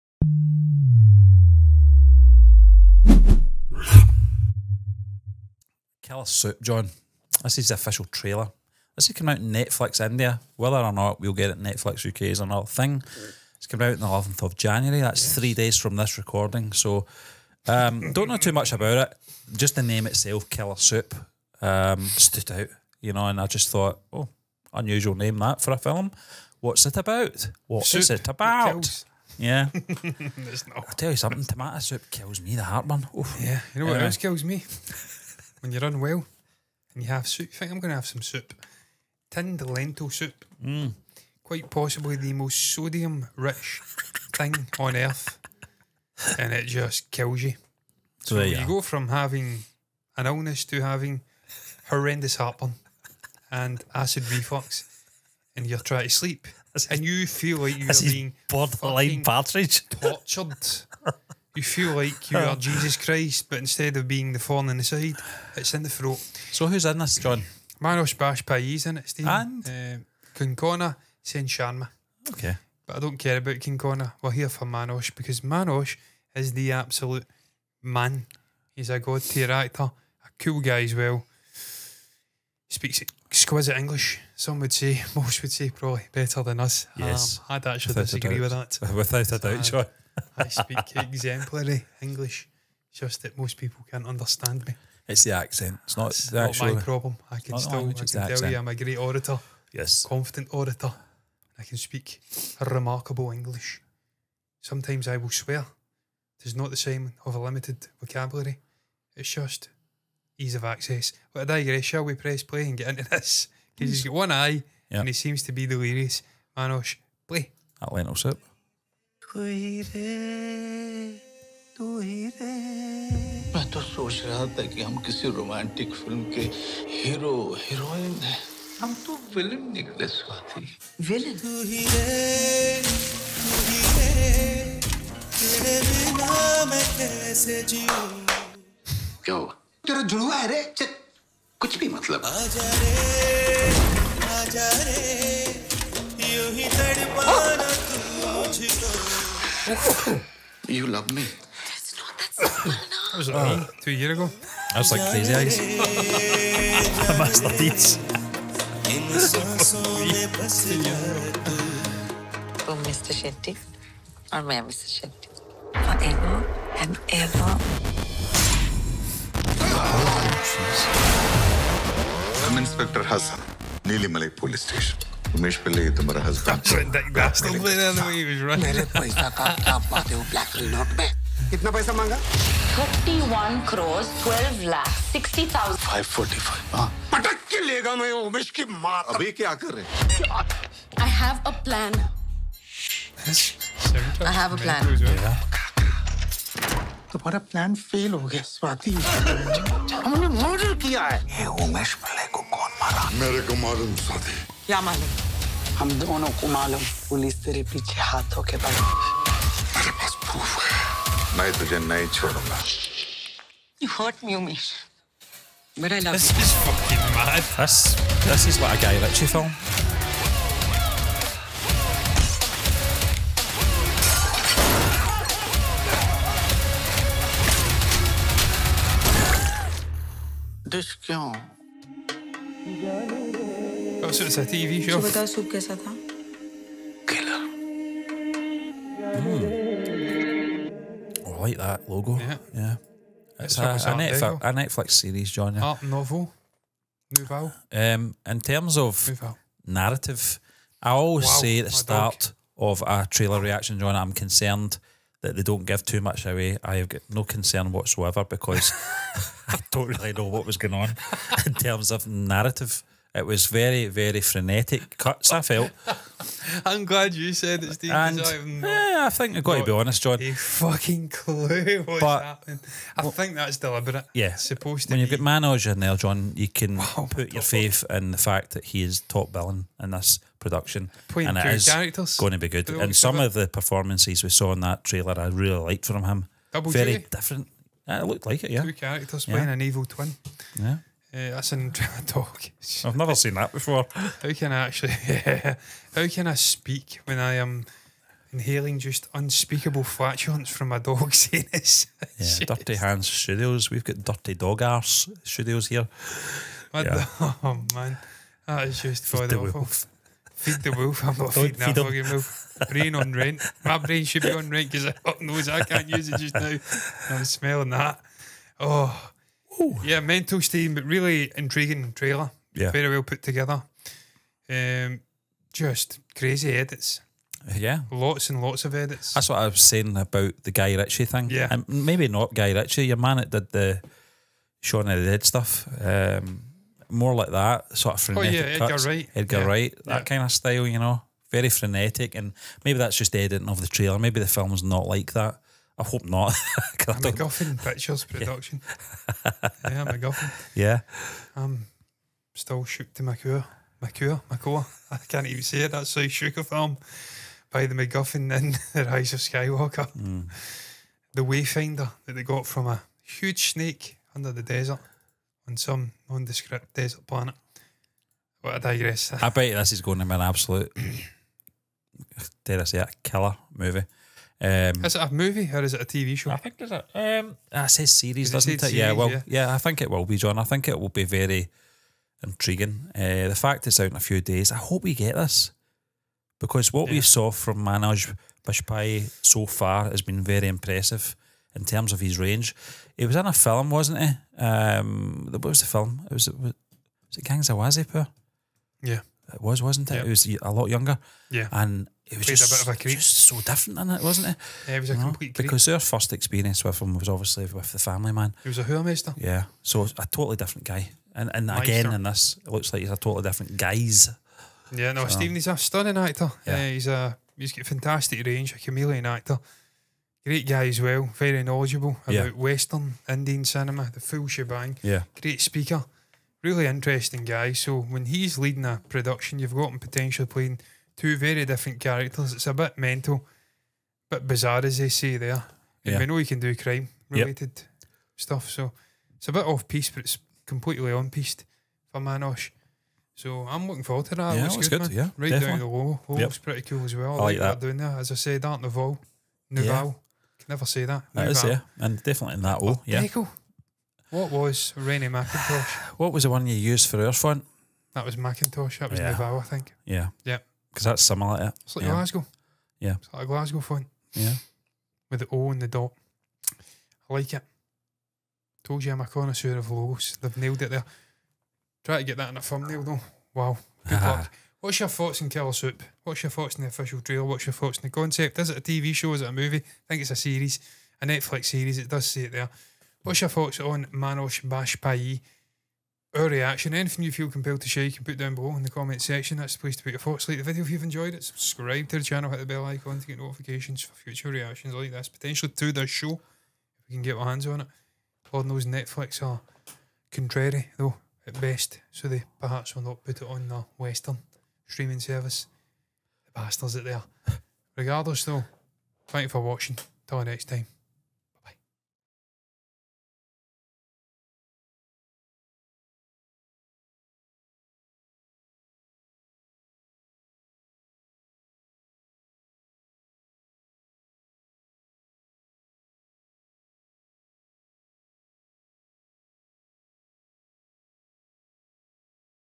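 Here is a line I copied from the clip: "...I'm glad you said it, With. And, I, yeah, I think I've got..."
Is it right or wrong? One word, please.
wrong.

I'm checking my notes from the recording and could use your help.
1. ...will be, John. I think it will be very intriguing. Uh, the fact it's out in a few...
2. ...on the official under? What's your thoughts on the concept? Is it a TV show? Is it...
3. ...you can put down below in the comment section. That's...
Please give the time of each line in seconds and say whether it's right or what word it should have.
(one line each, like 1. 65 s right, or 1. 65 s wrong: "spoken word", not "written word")
1. 379 s right
2. 476 s wrong: "trailer", not "under"
3. 487 s right.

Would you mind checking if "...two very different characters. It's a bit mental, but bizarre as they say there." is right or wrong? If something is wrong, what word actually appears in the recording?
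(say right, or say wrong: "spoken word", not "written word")
right.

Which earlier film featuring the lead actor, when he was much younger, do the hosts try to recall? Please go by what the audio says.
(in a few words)
Gangs of Wasseypur.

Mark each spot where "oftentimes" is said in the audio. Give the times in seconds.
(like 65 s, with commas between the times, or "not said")
not said.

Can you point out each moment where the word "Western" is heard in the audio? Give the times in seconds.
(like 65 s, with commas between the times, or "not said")
422 s, 503 s.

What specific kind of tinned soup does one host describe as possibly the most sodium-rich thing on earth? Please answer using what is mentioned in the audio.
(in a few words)
Lentil soup.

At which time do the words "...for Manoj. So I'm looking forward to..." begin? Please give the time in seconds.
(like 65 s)
441 s.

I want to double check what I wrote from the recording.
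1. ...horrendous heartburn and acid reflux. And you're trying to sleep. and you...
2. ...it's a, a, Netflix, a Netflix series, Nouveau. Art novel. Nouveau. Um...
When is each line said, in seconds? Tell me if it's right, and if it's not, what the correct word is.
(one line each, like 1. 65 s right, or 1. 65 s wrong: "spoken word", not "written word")
1. 51 s right
2. 243 s wrong: "John", not "Nouveau".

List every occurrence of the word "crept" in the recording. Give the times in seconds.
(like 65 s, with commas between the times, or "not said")
not said.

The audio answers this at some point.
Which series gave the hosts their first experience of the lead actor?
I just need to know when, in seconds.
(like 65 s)
407 s.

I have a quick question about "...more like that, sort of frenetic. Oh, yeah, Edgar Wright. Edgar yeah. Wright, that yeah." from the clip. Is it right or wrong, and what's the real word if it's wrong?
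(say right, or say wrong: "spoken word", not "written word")
right.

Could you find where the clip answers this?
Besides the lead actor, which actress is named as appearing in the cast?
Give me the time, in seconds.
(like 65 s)
70 s.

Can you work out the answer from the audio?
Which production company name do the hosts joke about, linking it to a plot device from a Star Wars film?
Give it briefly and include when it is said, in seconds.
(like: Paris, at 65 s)
MacGuffin Pictures, at 347 s.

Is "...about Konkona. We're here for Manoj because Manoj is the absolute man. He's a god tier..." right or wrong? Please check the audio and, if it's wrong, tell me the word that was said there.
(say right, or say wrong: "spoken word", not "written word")
right.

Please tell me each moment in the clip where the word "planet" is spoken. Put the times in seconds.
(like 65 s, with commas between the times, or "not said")
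367 s.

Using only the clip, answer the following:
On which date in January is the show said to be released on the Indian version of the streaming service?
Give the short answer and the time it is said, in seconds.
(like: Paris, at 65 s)
11th of January, at 14 s.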